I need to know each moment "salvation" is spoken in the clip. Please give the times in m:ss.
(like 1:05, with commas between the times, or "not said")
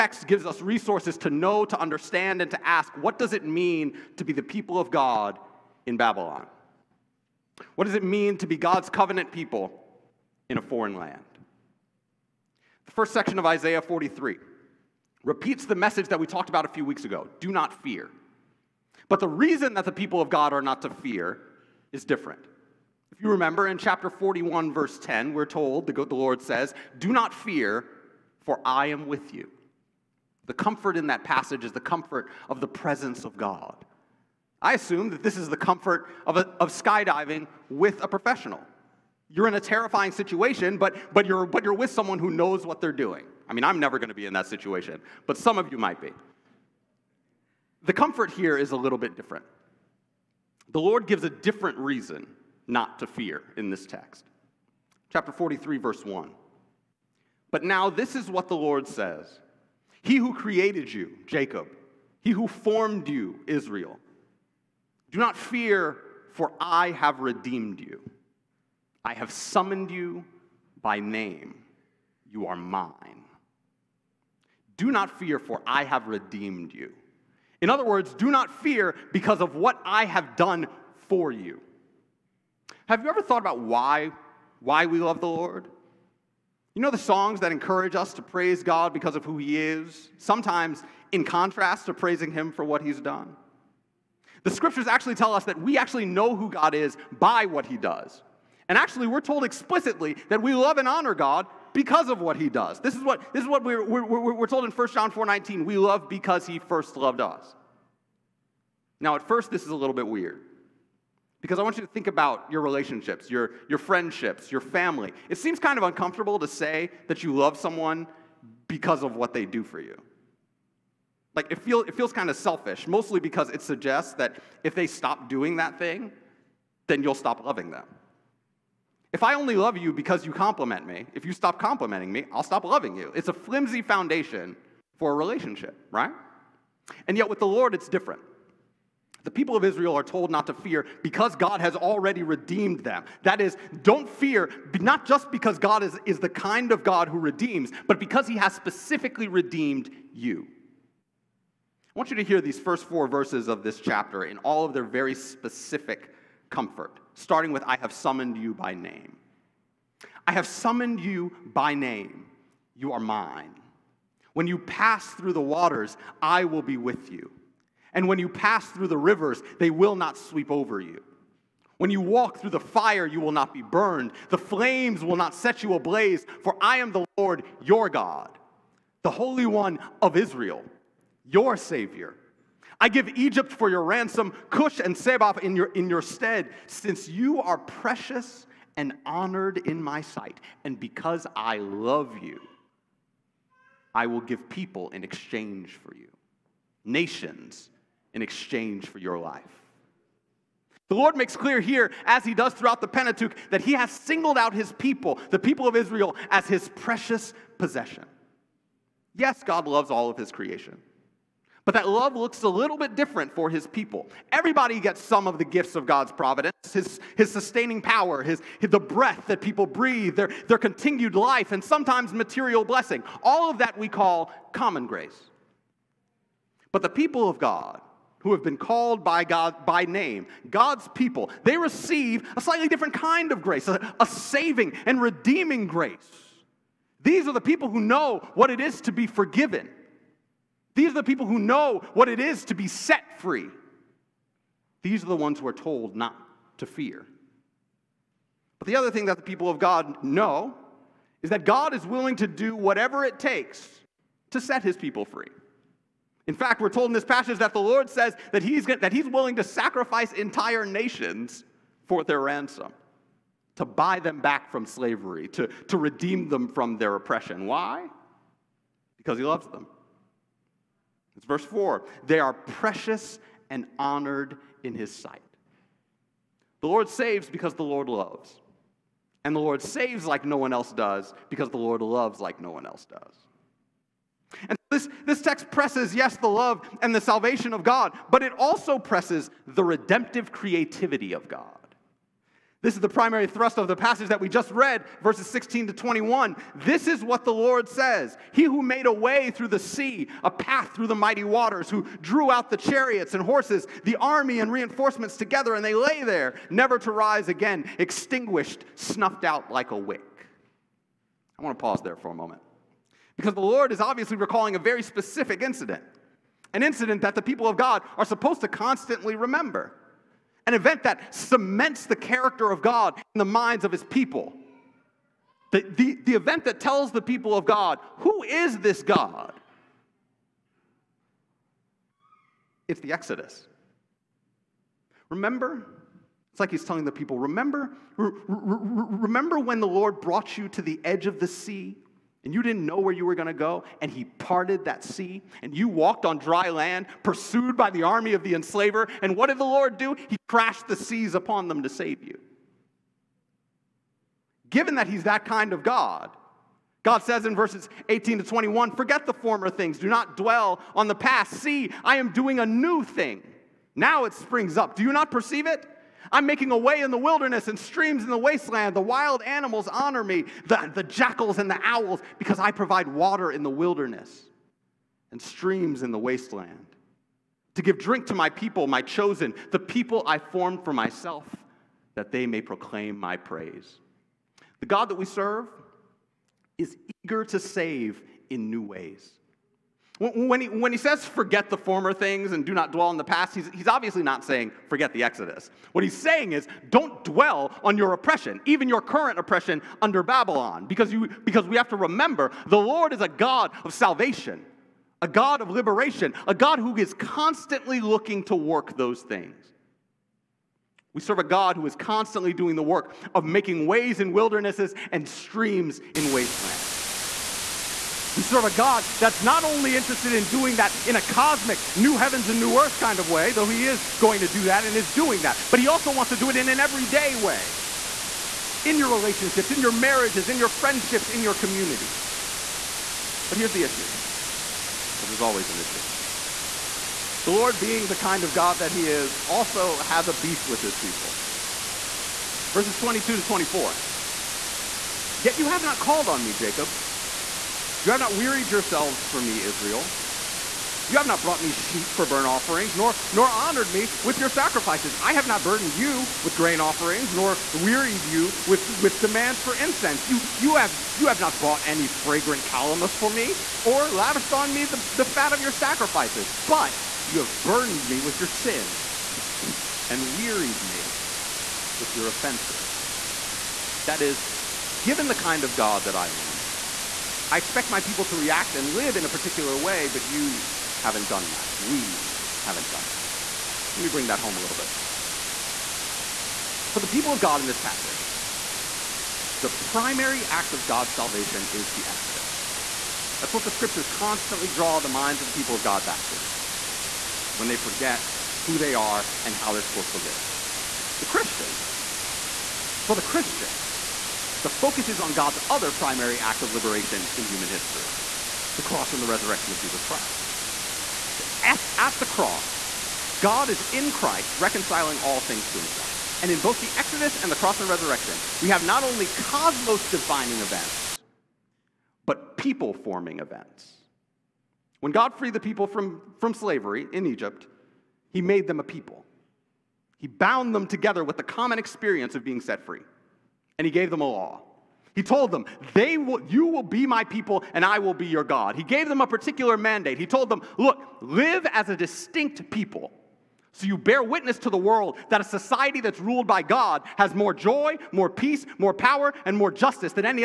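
4:47, 6:43, 8:10.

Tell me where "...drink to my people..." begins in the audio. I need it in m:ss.
6:17.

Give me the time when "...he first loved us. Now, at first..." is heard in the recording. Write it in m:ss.
1:46.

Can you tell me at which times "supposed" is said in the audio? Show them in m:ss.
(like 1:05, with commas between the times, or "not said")
5:18, 8:19.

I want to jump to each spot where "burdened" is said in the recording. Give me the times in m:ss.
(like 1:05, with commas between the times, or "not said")
7:35, 7:47.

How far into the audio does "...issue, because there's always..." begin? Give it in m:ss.
7:13.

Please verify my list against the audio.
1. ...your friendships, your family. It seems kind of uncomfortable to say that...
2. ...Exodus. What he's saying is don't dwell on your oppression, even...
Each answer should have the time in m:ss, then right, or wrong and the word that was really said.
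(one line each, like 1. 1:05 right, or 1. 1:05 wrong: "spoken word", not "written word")
1. 1:53 right
2. 6:35 right.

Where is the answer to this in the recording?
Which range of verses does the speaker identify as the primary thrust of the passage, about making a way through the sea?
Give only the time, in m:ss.
4:55.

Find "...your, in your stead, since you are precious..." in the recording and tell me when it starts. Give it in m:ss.
3:05.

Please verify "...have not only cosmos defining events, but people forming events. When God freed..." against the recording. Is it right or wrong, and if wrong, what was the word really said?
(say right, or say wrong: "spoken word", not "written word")
right.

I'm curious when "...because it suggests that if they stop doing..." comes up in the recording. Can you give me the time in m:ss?
2:03.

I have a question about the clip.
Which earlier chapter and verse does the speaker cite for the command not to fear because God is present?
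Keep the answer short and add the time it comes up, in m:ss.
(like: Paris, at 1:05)
Chapter 41, verse 10, at 0:23.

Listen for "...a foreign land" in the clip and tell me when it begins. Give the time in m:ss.
0:10.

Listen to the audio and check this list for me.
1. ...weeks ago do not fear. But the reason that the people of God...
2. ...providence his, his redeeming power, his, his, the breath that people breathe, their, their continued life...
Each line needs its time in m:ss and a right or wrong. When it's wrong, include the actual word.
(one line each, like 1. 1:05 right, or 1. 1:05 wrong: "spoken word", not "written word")
1. 0:16 right
2. 3:36 wrong: "sustaining", not "redeeming".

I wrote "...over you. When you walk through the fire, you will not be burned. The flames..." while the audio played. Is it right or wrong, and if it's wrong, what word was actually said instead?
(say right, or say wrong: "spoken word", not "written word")
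right.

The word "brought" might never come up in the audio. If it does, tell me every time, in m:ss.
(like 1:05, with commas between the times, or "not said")
5:40, 7:31.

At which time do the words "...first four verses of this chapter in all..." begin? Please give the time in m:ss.
2:32.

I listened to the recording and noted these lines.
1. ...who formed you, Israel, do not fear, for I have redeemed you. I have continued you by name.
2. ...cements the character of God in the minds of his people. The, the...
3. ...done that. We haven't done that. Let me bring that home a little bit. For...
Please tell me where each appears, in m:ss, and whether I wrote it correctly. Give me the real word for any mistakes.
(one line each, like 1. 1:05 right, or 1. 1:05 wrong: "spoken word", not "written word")
1. 1:02 wrong: "summoned", not "continued"
2. 5:21 right
3. 8:01 right.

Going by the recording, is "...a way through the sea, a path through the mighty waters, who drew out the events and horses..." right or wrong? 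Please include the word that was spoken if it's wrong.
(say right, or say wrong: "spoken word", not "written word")
wrong: "chariots", not "events".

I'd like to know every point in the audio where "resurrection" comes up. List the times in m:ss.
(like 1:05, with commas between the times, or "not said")
8:29, 8:37.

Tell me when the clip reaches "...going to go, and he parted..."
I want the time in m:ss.
5:43.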